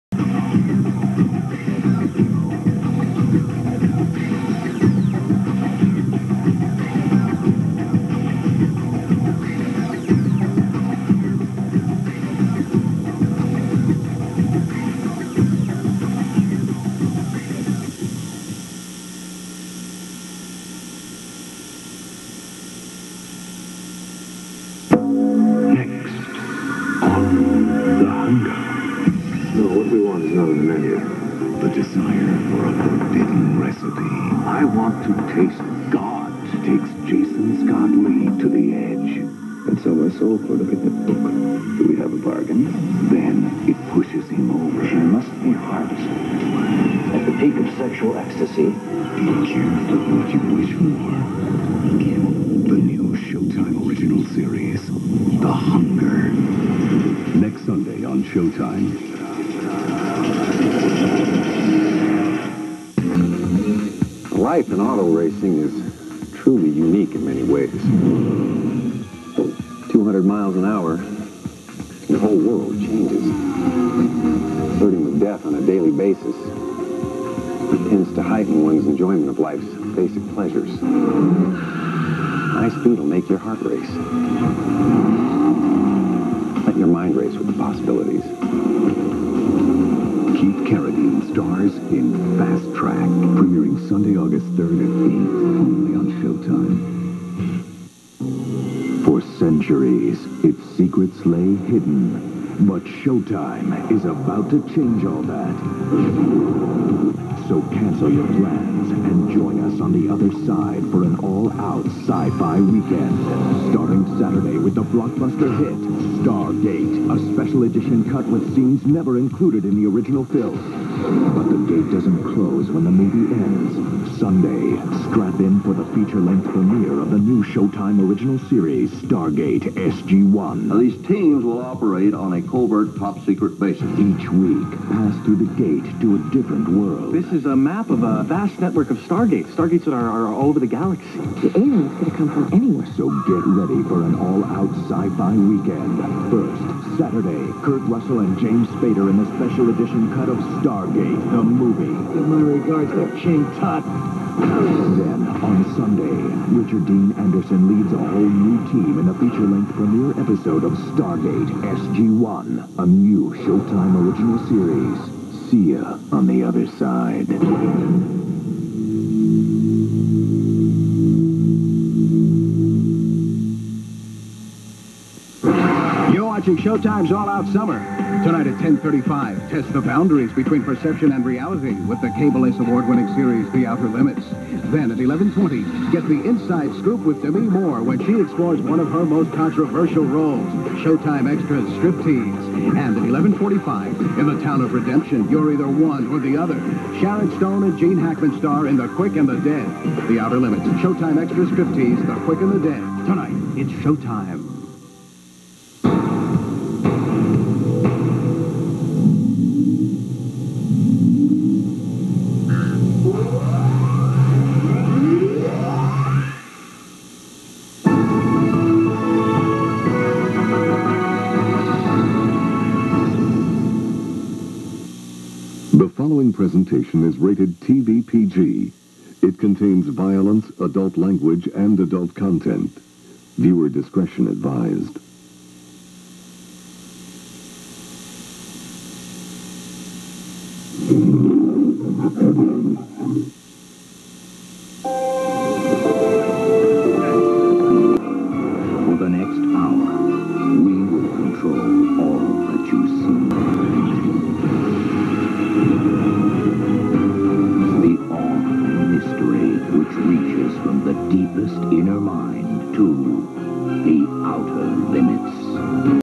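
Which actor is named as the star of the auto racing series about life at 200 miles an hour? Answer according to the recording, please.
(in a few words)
Keith Carradine.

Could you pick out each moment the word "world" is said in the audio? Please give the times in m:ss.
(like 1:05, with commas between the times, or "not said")
1:12, 2:16.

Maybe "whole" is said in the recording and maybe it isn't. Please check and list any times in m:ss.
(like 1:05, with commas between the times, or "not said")
1:12, 2:37.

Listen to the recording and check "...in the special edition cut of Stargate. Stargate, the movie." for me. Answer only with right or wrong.
right.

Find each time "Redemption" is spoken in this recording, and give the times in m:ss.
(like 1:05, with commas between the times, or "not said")
3:14.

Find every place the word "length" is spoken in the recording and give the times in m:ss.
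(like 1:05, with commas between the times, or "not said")
2:05, 2:39.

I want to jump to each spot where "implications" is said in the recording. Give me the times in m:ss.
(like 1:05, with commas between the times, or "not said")
not said.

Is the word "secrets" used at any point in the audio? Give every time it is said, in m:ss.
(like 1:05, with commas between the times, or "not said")
1:40, 2:12.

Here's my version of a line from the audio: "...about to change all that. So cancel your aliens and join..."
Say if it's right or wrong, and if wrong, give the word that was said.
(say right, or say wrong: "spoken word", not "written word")
wrong: "plans", not "aliens".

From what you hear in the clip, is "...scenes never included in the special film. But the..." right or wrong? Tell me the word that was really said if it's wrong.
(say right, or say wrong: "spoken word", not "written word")
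wrong: "original", not "special".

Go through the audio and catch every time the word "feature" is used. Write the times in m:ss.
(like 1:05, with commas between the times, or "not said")
2:05, 2:39.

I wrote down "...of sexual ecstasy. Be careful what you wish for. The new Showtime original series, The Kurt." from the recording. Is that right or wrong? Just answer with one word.
wrong.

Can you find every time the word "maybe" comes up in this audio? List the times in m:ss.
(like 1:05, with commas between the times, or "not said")
not said.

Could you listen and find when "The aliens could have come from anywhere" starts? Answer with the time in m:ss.
2:21.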